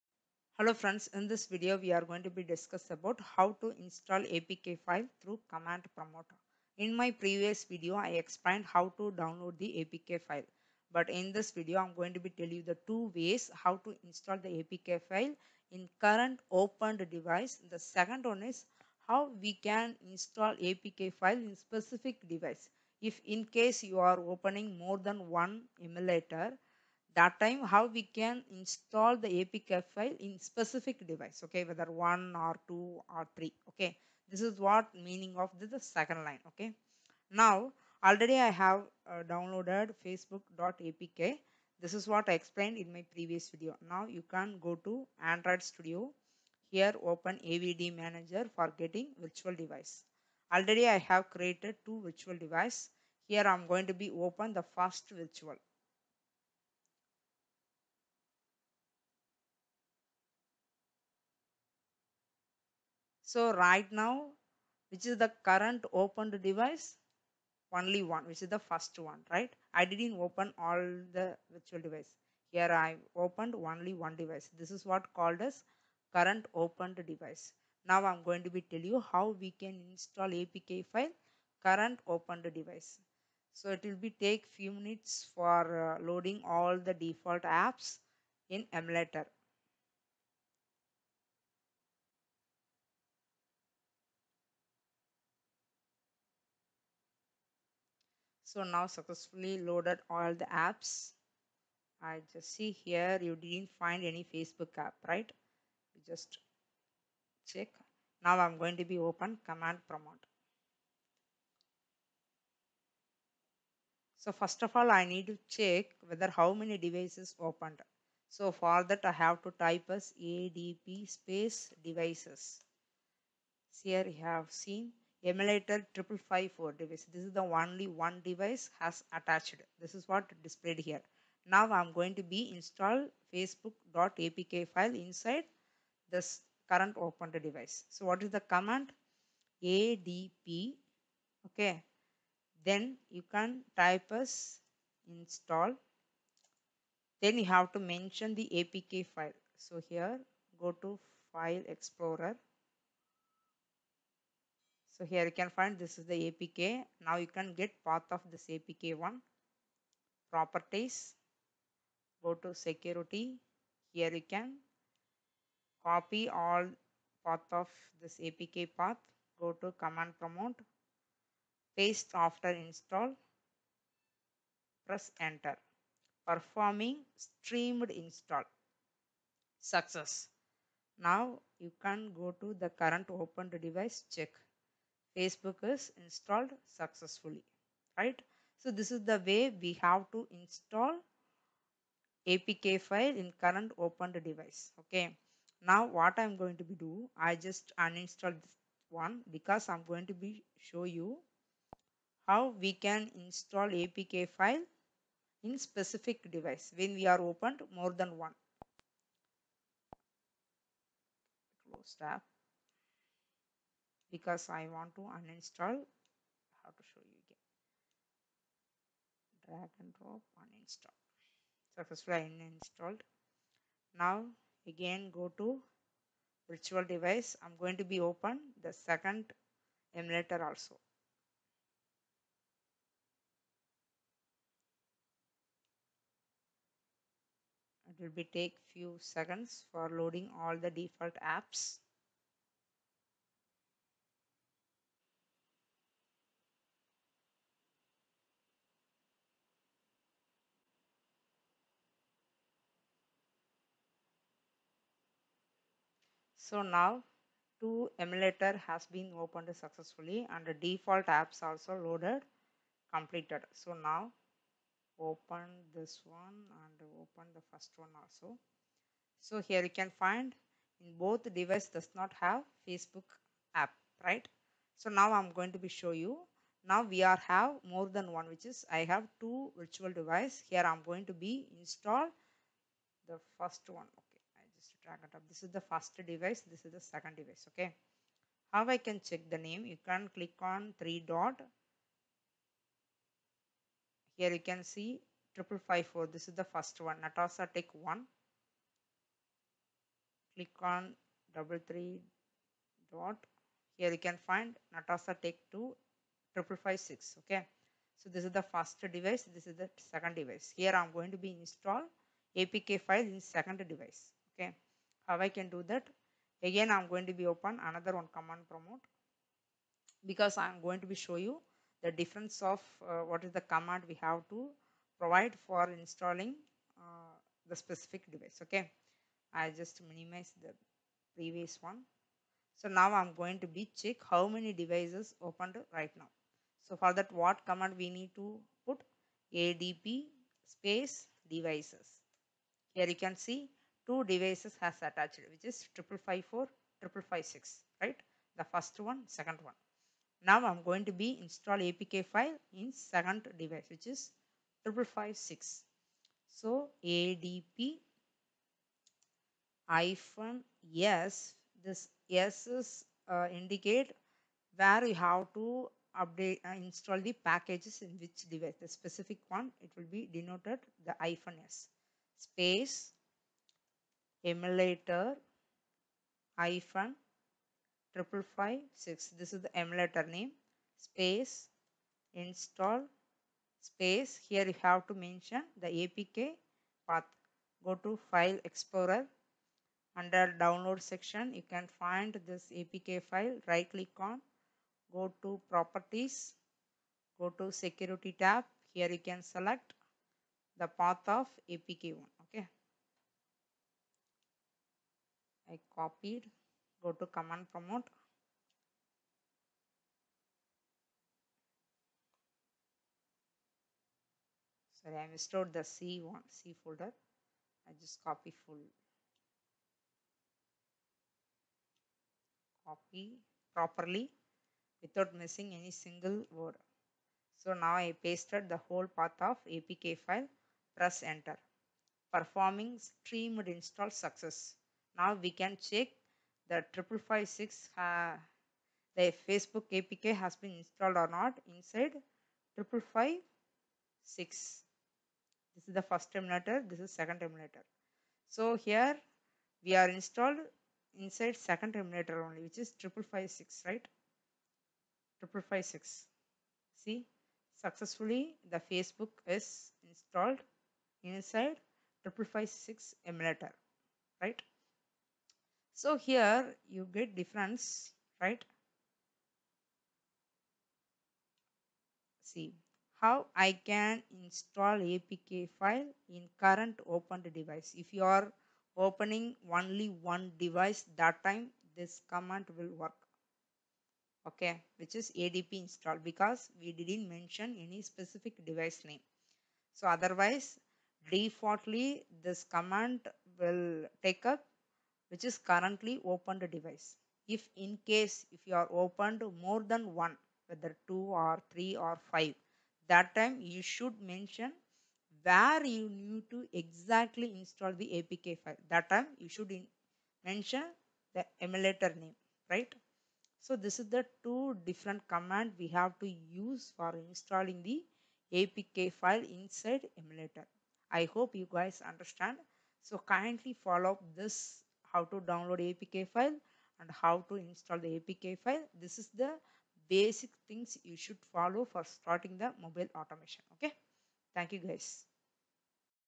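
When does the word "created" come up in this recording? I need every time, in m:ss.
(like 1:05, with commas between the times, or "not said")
0:51.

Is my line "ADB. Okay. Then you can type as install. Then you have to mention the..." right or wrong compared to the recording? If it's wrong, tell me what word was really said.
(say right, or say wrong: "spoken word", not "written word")
right.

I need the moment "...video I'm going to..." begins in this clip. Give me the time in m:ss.
0:11.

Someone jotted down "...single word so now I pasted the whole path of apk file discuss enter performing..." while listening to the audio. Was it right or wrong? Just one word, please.
wrong.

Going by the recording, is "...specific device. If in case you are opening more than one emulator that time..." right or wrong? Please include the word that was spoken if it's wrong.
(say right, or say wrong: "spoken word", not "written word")
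right.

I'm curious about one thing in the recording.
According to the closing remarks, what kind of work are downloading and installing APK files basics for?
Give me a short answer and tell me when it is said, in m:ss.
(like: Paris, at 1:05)
mobile automation, at 8:52.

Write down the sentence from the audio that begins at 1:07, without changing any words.
Only one, which is the first one, right?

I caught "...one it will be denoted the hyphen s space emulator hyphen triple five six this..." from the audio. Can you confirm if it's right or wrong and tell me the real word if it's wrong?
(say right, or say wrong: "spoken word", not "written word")
right.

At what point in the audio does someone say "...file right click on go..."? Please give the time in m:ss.
6:33.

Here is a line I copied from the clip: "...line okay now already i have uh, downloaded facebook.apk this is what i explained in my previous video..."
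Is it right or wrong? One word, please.
right.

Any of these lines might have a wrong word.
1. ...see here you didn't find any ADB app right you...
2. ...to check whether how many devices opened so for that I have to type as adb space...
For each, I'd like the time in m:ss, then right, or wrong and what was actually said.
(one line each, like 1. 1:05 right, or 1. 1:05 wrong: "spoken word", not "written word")
1. 1:42 wrong: "Facebook", not "ADB"
2. 1:55 right.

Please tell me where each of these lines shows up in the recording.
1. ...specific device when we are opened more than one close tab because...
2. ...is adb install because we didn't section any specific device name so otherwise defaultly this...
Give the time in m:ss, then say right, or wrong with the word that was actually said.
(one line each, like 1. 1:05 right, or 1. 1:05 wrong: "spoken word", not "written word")
1. 3:25 right
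2. 8:04 wrong: "mention", not "section".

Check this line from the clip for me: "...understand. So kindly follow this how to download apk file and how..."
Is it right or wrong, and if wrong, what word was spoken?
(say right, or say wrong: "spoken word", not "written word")
right.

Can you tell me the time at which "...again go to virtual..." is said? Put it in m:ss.
3:44.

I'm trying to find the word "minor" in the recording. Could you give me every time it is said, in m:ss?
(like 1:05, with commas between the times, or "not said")
not said.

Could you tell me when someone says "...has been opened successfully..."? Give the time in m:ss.
4:18.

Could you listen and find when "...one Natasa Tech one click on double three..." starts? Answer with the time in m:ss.
4:56.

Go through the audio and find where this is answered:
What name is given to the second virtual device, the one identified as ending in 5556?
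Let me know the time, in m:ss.
5:04.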